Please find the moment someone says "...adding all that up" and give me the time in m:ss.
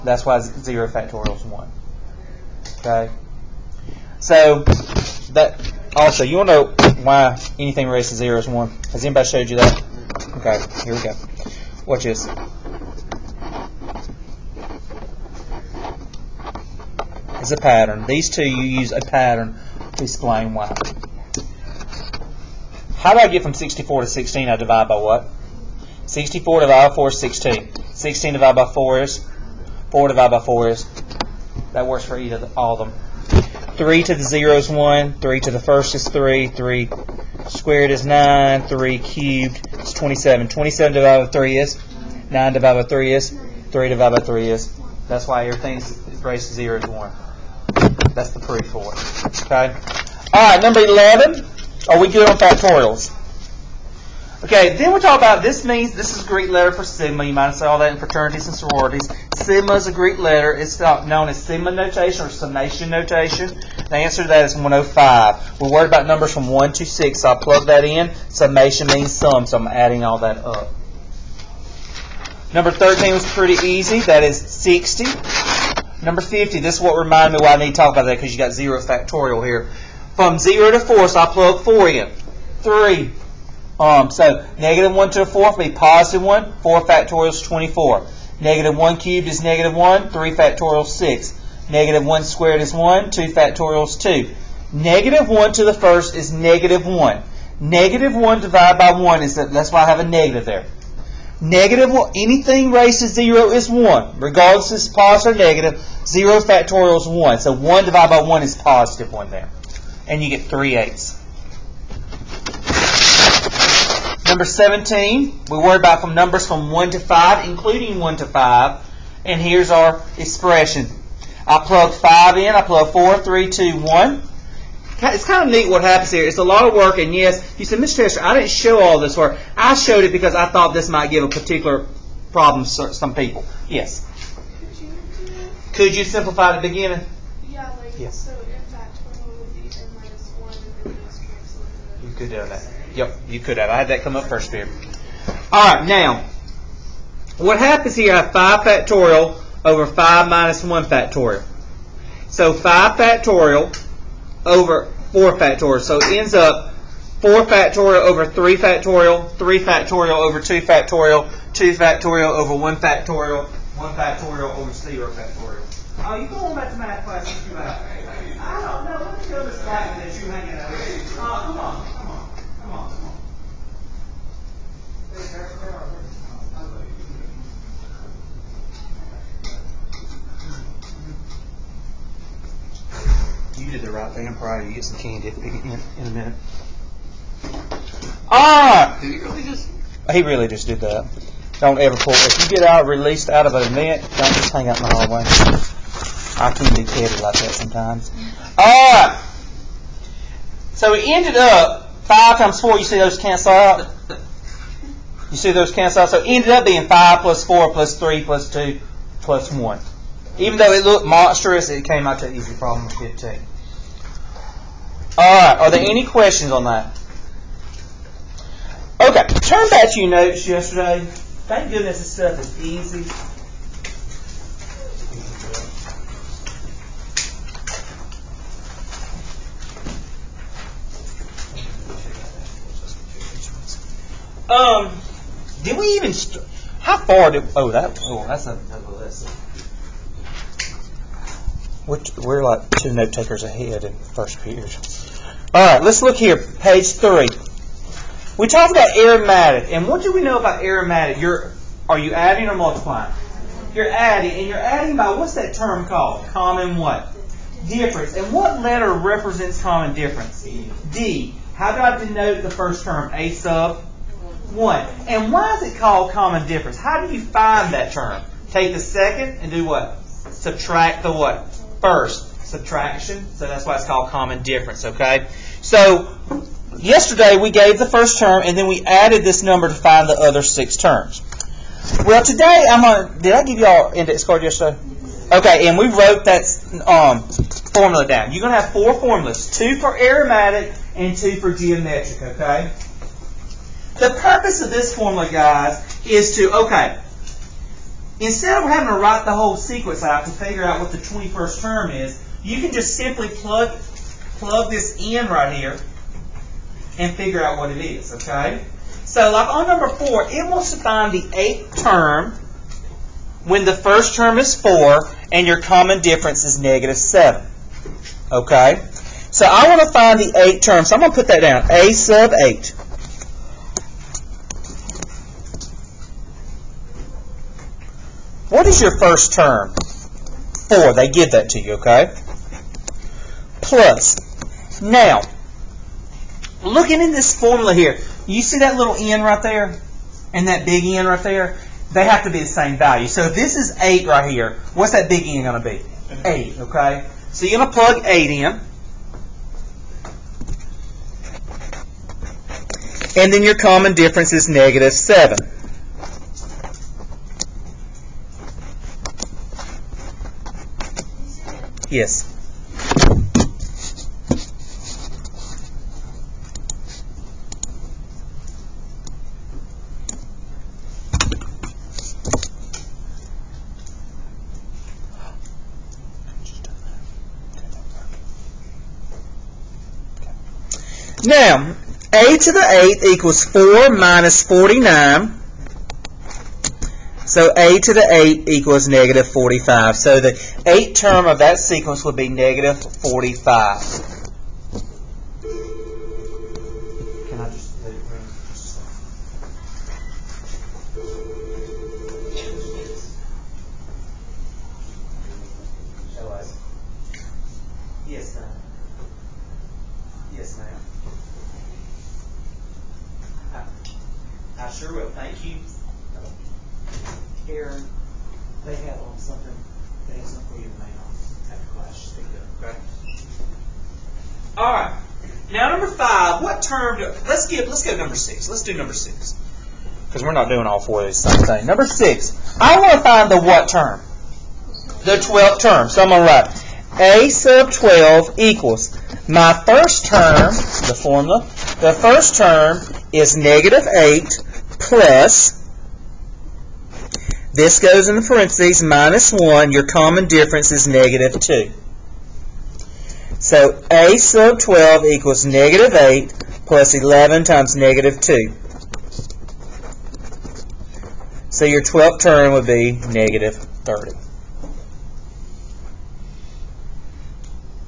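1:09.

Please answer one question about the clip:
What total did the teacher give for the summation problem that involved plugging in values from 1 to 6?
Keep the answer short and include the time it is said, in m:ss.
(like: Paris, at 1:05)
105, at 1:04.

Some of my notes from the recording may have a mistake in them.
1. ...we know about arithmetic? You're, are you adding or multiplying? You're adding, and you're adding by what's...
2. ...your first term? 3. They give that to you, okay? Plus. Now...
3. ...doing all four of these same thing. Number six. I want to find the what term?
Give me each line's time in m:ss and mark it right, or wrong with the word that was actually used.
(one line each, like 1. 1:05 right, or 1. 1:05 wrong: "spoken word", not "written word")
1. 4:10 right
2. 5:28 wrong: "4", not "3"
3. 7:10 right.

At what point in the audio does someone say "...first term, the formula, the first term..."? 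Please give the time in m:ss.
7:19.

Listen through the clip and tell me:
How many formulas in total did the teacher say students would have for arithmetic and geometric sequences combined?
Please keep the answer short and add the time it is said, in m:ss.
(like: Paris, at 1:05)
4, at 4:48.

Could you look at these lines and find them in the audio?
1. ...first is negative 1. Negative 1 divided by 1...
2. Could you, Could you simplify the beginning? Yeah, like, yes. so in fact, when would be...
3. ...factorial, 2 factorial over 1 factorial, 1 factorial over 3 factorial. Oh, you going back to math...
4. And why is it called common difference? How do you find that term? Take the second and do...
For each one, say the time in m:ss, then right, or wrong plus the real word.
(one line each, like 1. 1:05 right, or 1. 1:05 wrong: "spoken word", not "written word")
1. 1:35 right
2. 2:14 right
3. 2:40 wrong: "0", not "3"
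4. 4:25 right.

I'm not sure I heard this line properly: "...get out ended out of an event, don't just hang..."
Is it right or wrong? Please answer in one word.
wrong.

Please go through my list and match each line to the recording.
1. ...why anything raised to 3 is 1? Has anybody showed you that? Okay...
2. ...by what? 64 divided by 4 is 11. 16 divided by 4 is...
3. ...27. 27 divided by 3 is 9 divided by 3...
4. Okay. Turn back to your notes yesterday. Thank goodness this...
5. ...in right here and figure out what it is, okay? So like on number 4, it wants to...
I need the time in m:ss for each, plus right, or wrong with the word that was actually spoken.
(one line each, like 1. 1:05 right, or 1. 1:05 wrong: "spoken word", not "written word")
1. 0:07 wrong: "0", not "3"
2. 0:24 wrong: "16", not "11"
3. 0:39 right
4. 3:39 right
5. 5:05 right.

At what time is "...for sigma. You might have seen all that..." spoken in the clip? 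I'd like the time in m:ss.
0:56.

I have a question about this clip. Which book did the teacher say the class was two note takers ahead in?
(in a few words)
First Peter.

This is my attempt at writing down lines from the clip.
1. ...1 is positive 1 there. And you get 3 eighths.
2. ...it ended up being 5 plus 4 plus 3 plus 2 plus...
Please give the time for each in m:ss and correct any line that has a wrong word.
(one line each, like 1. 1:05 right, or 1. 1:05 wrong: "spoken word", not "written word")
1. 1:48 right
2. 3:26 right.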